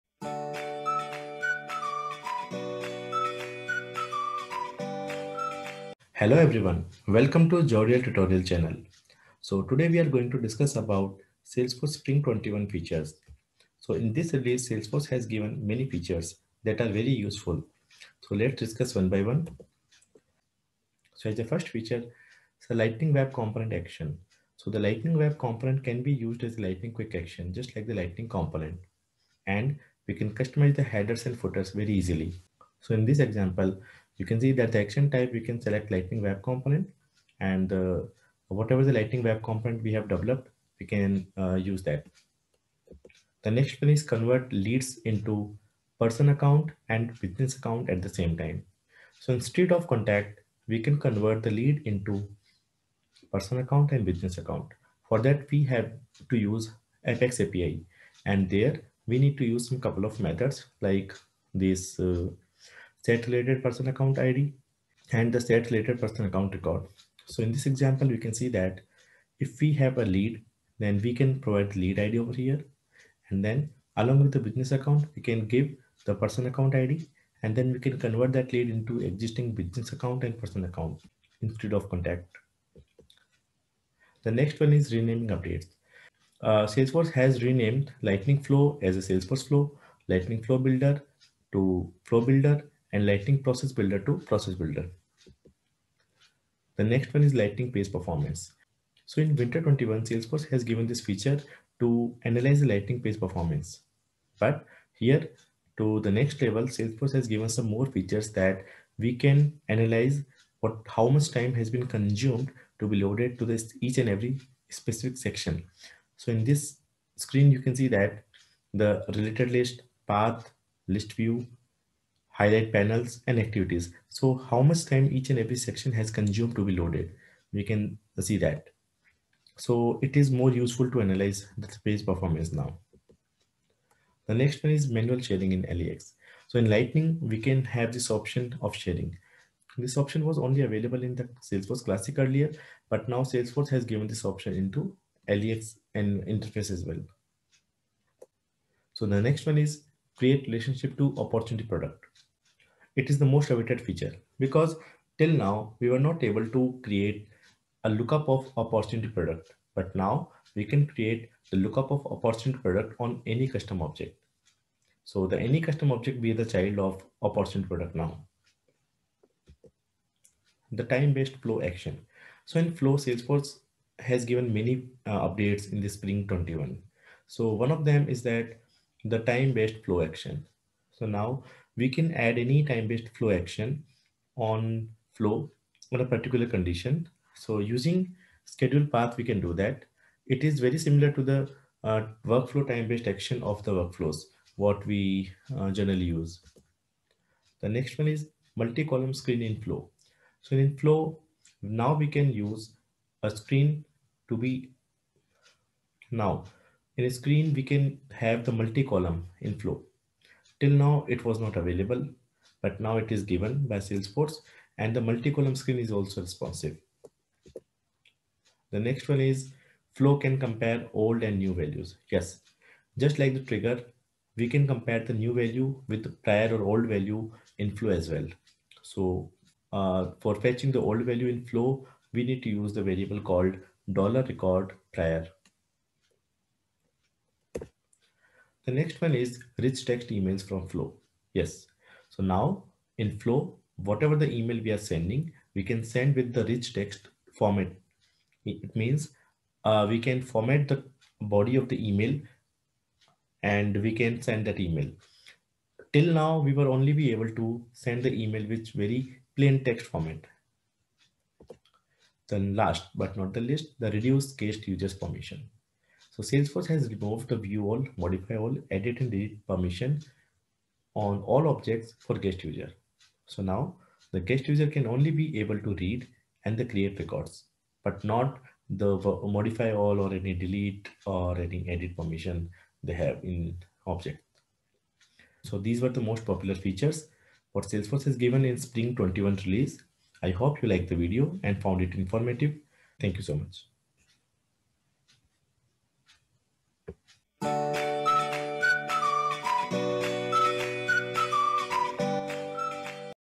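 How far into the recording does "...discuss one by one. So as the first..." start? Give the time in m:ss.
0:18.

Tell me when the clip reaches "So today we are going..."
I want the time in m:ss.
0:09.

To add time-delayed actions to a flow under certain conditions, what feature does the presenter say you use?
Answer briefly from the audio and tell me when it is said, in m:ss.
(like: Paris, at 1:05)
schedule path, at 3:08.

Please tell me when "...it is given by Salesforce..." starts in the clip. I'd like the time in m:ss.
3:32.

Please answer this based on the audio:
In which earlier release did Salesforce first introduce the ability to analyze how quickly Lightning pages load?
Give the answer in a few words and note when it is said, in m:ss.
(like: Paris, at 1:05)
Winter 21, at 1:39.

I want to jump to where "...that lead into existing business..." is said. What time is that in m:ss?
1:18.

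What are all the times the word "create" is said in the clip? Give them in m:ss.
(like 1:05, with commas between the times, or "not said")
2:30, 2:36, 2:40, 4:36.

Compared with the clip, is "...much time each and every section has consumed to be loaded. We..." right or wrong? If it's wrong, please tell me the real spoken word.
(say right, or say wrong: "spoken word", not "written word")
right.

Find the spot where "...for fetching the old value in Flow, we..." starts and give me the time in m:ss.
3:50.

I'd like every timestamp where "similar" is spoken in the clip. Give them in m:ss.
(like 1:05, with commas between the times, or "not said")
3:10.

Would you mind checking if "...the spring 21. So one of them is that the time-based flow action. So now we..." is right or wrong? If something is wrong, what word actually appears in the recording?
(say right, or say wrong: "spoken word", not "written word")
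right.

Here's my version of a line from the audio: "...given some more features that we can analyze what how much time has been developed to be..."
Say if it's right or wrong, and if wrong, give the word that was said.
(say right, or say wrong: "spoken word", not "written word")
wrong: "consumed", not "developed".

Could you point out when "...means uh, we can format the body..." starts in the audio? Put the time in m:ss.
4:08.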